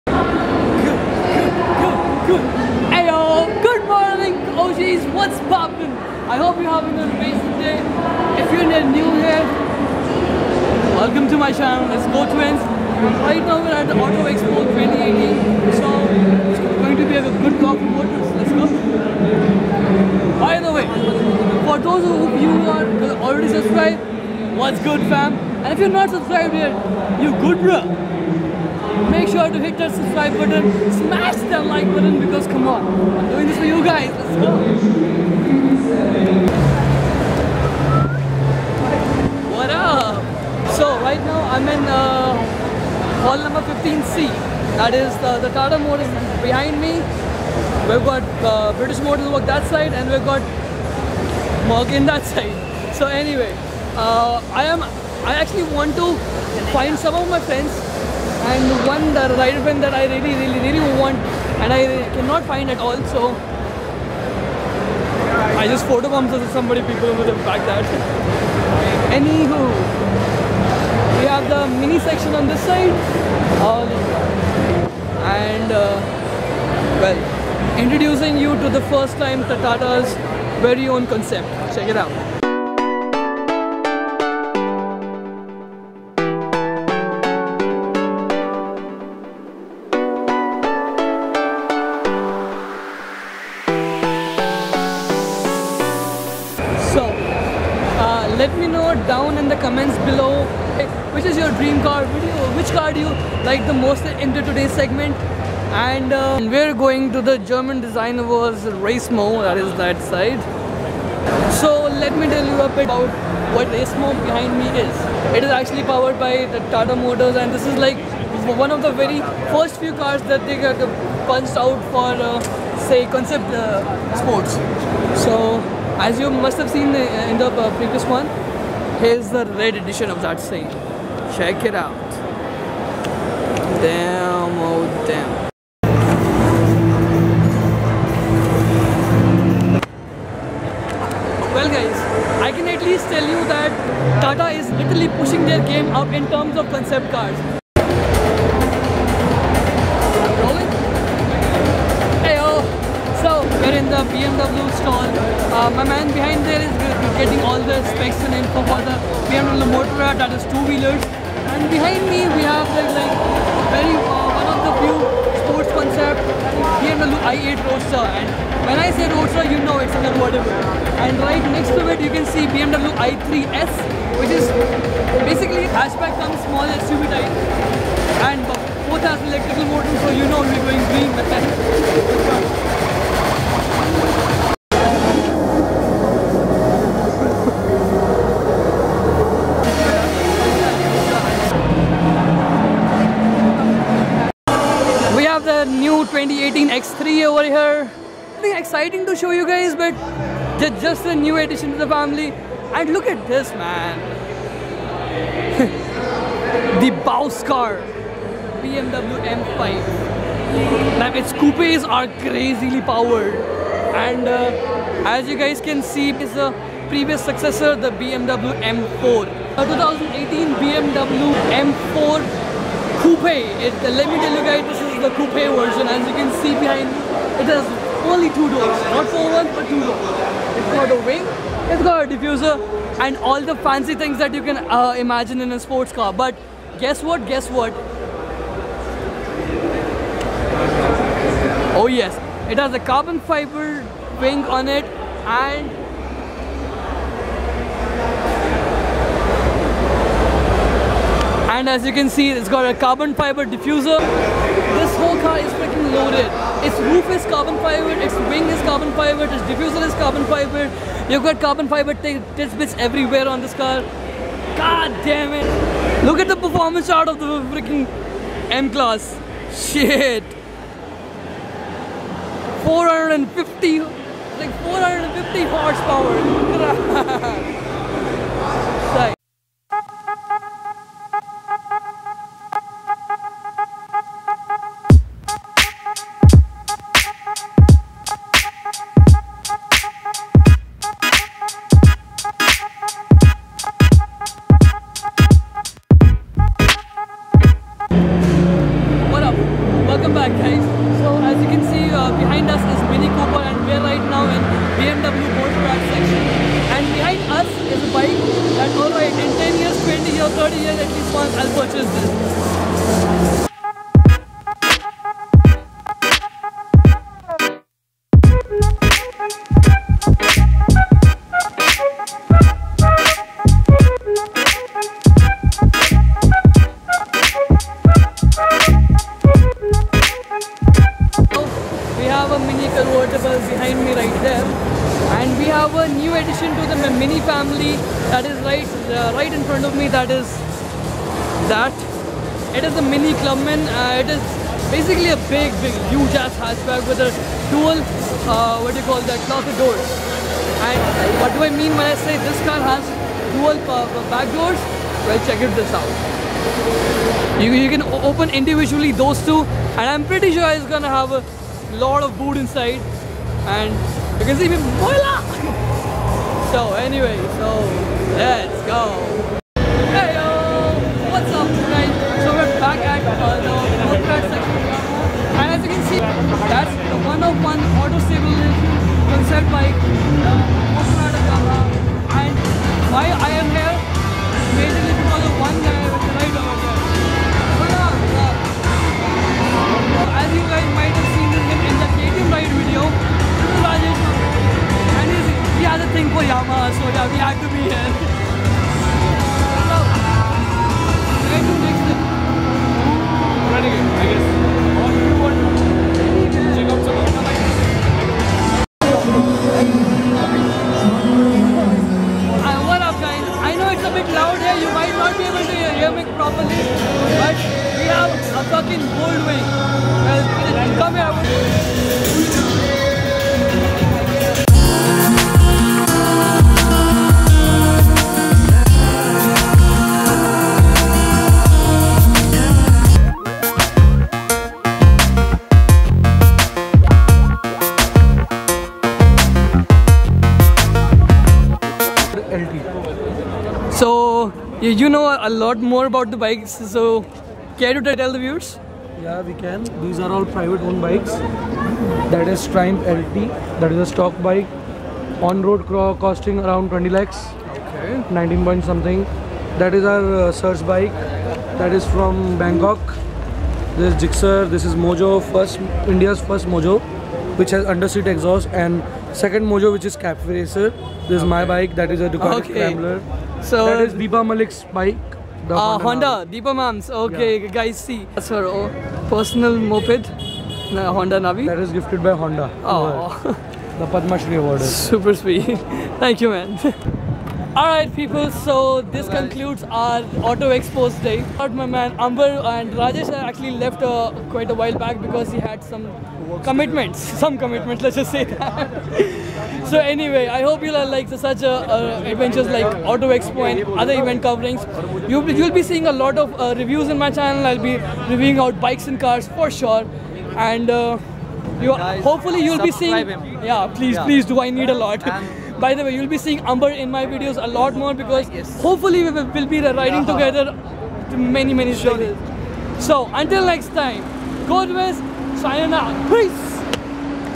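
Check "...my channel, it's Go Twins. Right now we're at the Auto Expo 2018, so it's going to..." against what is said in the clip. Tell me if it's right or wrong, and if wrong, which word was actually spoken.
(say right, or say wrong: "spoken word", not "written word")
right.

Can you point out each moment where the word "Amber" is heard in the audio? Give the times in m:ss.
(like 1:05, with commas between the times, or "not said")
8:11, 8:36.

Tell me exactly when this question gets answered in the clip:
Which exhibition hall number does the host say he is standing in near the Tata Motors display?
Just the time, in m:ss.
0:43.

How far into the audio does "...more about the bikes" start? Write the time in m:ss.
7:25.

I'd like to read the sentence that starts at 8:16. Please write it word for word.
Some commitments, let's just say that.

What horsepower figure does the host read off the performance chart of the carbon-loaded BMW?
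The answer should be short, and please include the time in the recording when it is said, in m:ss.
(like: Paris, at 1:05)
450, at 4:34.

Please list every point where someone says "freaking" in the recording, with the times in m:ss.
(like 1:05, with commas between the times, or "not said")
4:15, 4:27.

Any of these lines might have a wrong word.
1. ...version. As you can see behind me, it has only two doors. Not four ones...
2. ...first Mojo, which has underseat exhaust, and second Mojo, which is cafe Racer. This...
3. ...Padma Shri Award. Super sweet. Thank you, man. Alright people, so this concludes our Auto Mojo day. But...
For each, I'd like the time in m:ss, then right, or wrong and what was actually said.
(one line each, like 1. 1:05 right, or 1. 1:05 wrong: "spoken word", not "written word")
1. 3:45 right
2. 7:46 right
3. 8:03 wrong: "Expos", not "Mojo".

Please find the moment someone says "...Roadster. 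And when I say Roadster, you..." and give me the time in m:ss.
2:47.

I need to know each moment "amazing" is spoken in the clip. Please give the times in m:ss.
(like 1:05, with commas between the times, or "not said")
0:07.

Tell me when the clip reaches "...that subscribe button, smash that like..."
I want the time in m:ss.
0:29.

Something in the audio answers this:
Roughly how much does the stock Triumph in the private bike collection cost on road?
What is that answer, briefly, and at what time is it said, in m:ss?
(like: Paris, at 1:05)
20 lakhs, at 7:36.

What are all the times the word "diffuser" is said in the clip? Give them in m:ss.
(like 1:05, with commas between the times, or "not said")
3:52, 4:13, 4:19.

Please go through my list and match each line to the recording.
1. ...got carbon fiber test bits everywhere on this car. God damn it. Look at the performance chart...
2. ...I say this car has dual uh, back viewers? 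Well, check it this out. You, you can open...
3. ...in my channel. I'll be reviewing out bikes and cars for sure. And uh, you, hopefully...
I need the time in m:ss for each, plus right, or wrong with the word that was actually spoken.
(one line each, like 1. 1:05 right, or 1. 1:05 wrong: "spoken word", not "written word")
1. 4:21 right
2. 5:51 wrong: "doors", not "viewers"
3. 8:26 right.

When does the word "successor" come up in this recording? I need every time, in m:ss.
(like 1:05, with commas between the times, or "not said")
3:37.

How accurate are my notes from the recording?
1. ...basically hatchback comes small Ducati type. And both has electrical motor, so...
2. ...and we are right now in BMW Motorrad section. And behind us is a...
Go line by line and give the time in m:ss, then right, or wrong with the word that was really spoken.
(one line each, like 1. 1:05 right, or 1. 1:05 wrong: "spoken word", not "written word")
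1. 2:55 wrong: "SUV", not "Ducati"
2. 5:03 right.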